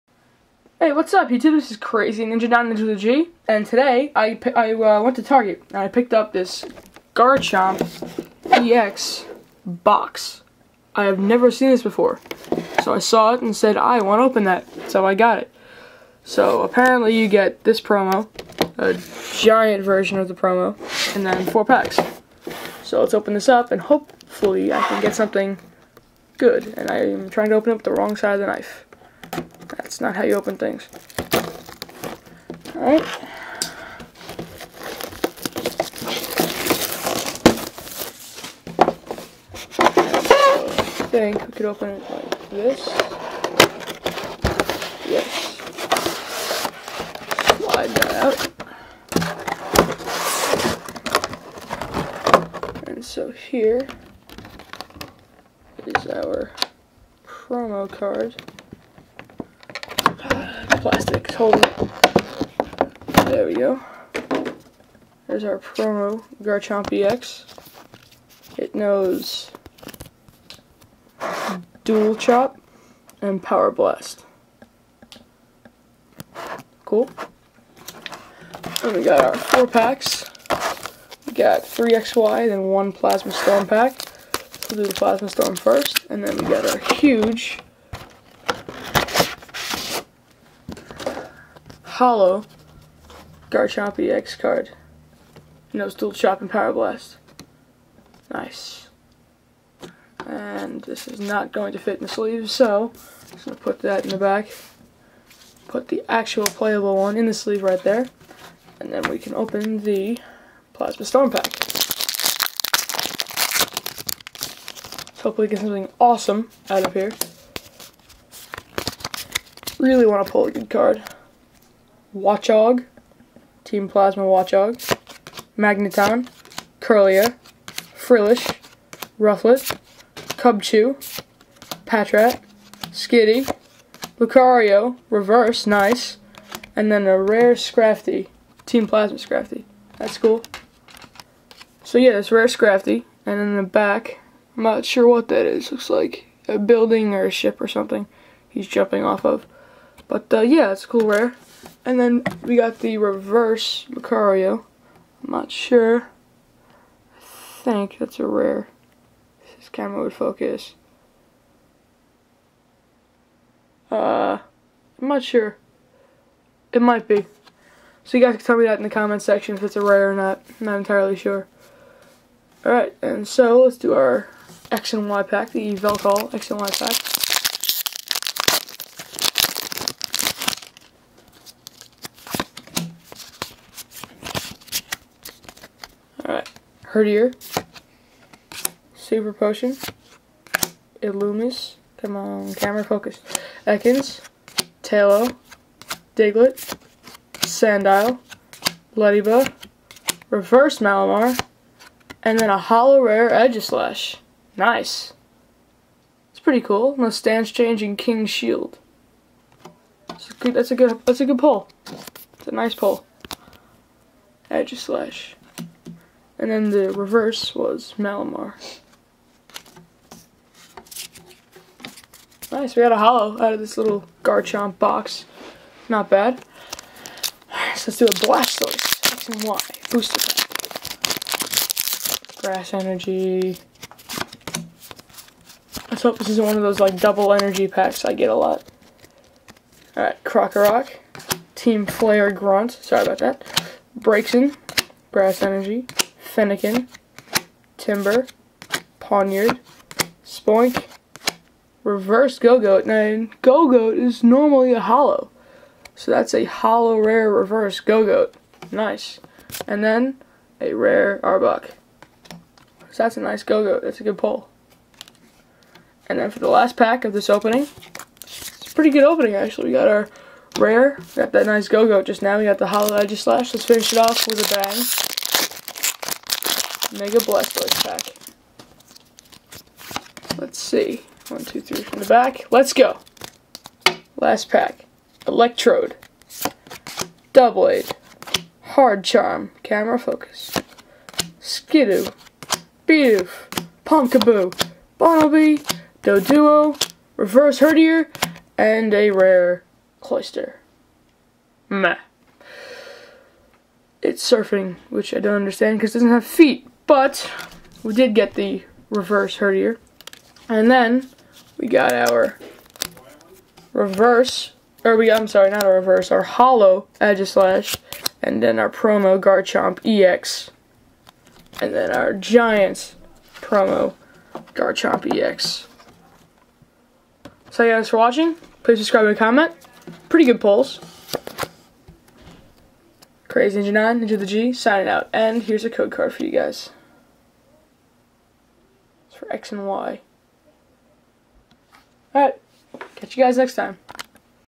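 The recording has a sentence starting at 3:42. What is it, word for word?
Nice, we got a hollow out of this little Garchomp box.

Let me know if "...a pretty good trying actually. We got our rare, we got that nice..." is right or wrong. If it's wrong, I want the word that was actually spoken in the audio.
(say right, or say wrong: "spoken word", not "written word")
wrong: "opening", not "trying".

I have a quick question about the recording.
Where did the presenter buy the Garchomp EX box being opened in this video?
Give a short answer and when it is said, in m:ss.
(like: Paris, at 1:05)
Target, at 0:05.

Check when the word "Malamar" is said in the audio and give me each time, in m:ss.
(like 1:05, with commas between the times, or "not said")
3:20, 3:37.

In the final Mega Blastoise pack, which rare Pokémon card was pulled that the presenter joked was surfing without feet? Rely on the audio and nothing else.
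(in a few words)
Cloyster.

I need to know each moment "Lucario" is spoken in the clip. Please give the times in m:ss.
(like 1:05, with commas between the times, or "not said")
2:14, 2:33.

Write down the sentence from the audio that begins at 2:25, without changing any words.
Looks like a building or a ship or something he's jumping off of.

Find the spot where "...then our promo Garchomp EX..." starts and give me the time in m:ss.
5:18.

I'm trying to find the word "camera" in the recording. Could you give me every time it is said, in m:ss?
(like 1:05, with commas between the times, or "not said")
2:39, 3:12, 4:49.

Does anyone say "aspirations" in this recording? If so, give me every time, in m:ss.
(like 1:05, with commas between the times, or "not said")
not said.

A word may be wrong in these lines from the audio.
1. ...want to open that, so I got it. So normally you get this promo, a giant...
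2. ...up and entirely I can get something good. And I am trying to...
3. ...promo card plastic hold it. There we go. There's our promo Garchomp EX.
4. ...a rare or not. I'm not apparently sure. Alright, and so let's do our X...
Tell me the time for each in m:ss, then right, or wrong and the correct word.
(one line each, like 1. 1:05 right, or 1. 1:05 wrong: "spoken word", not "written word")
1. 0:14 wrong: "apparently", not "normally"
2. 0:23 wrong: "hopefully", not "entirely"
3. 0:57 right
4. 2:49 wrong: "entirely", not "apparently".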